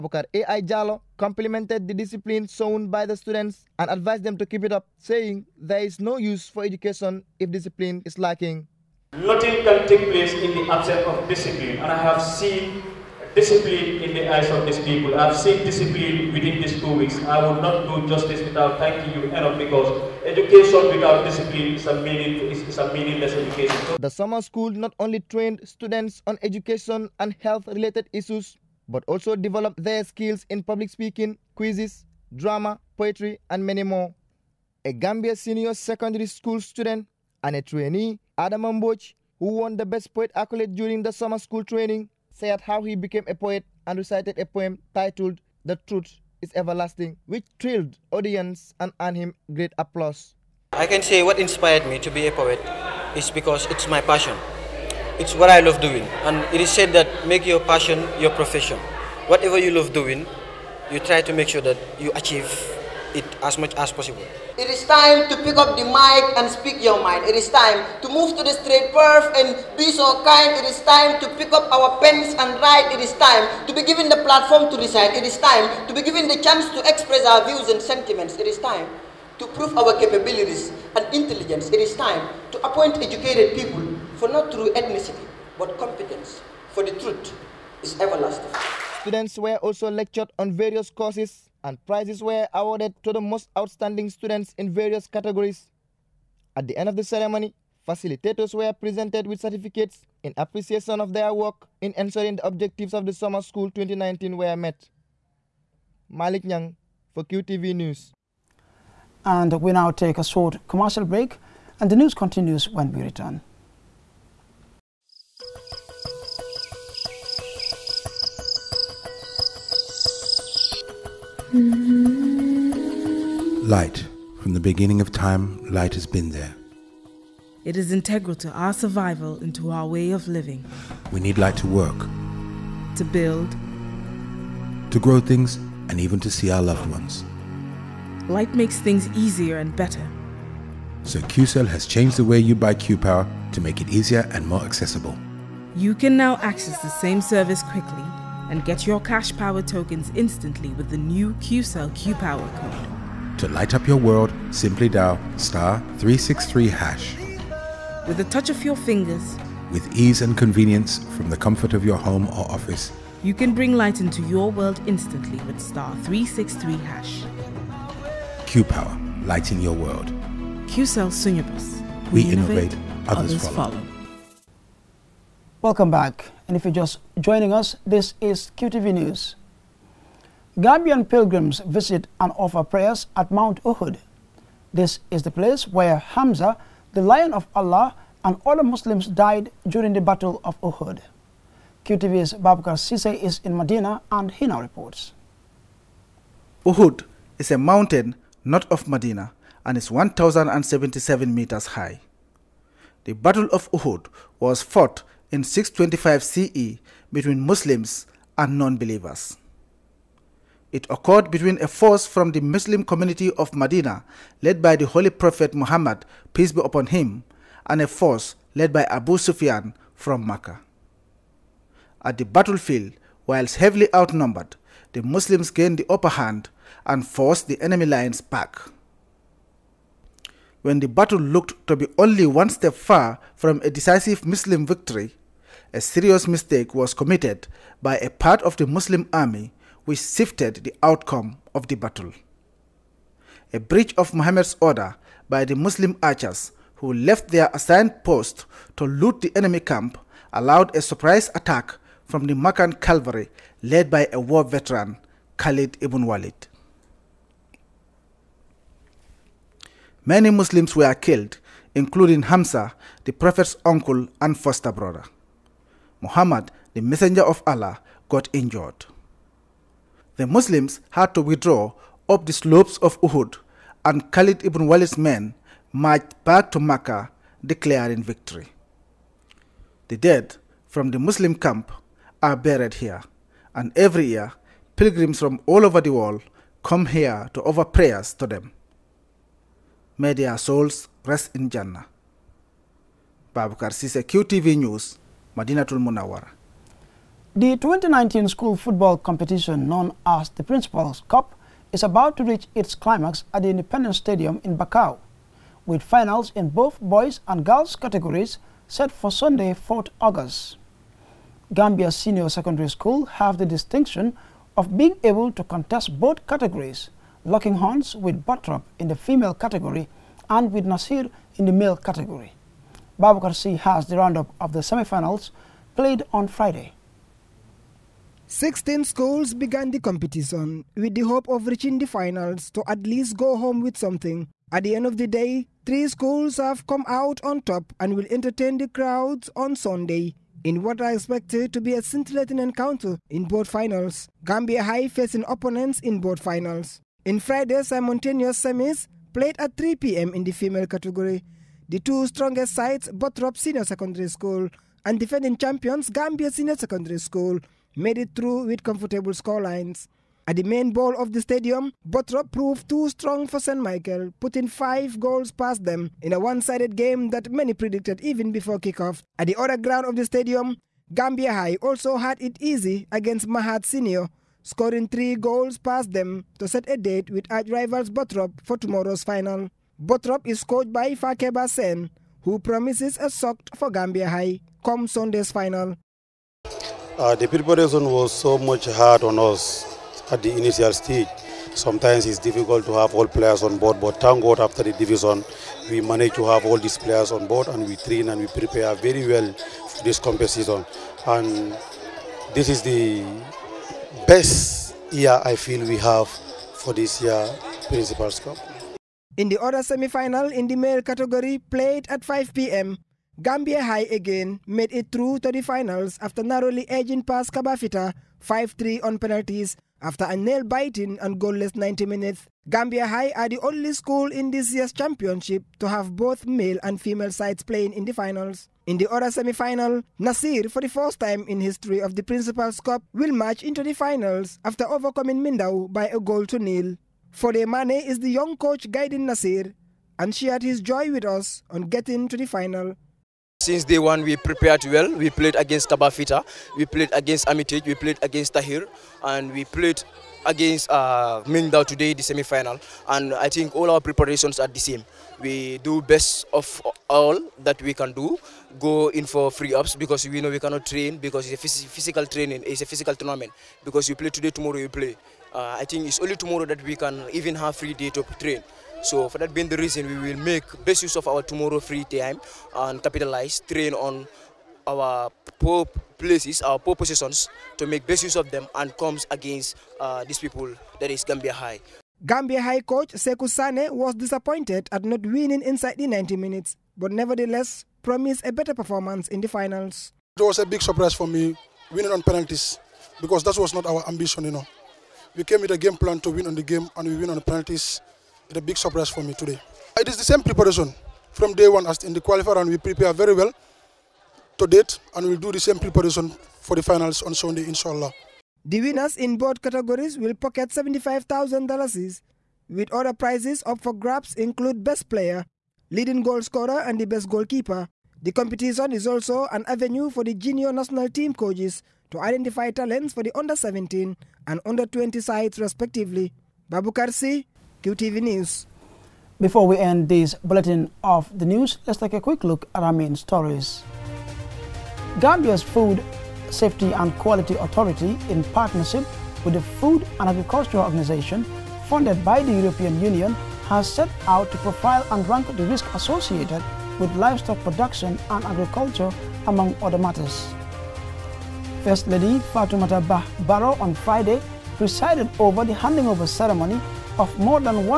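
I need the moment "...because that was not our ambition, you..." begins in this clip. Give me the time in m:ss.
8:13.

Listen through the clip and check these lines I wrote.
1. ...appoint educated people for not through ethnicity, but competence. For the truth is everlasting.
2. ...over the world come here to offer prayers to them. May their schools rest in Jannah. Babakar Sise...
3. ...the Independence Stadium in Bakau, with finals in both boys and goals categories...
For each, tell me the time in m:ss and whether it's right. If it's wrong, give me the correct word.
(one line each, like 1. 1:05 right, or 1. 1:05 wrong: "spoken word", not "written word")
1. 1:22 right
2. 4:45 wrong: "souls", not "schools"
3. 5:03 wrong: "girls", not "goals".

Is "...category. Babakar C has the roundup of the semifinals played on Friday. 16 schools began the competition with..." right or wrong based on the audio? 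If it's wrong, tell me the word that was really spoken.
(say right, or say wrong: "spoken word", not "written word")
right.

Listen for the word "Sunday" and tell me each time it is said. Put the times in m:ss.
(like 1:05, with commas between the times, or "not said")
5:09, 5:39, 6:24, 8:27.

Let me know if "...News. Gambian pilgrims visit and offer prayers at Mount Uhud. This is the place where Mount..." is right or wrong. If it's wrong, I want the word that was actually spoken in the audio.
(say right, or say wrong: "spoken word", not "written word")
wrong: "Hamza", not "Mount".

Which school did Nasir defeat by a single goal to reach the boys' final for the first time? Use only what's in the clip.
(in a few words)
Mindau.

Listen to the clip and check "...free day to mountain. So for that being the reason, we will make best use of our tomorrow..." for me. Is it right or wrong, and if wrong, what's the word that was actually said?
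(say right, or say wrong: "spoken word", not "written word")
wrong: "train", not "mountain".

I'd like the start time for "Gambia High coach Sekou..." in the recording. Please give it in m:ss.
8:02.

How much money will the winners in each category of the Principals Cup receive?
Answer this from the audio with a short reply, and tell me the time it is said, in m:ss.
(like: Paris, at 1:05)
$75,000, at 8:30.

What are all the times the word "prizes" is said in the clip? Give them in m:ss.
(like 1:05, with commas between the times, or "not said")
1:31, 8:32.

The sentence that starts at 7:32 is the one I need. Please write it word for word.
And I think all our preparations are the same.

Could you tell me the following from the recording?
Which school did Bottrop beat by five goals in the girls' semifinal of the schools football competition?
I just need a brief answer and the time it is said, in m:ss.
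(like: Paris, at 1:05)
St. Michael, at 6:03.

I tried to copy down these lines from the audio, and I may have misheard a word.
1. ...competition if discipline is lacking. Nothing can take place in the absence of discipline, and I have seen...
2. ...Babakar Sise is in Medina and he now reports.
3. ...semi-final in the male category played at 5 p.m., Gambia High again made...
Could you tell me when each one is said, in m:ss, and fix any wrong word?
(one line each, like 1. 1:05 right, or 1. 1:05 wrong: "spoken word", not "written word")
1. 0:06 wrong: "education", not "competition"
2. 3:12 right
3. 6:49 right.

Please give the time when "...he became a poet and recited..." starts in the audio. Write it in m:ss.
0:42.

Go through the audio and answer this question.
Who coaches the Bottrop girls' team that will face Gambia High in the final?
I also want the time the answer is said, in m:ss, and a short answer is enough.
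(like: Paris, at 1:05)
Fakeba Sen, at 6:20.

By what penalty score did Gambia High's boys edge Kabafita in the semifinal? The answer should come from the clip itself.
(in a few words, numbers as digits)
5-3.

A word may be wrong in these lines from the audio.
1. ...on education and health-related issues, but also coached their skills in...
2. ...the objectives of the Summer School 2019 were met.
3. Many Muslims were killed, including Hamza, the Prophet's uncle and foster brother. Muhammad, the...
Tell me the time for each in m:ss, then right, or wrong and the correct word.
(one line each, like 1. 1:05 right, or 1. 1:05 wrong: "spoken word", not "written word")
1. 0:26 wrong: "developed", not "coached"
2. 1:42 right
3. 4:20 right.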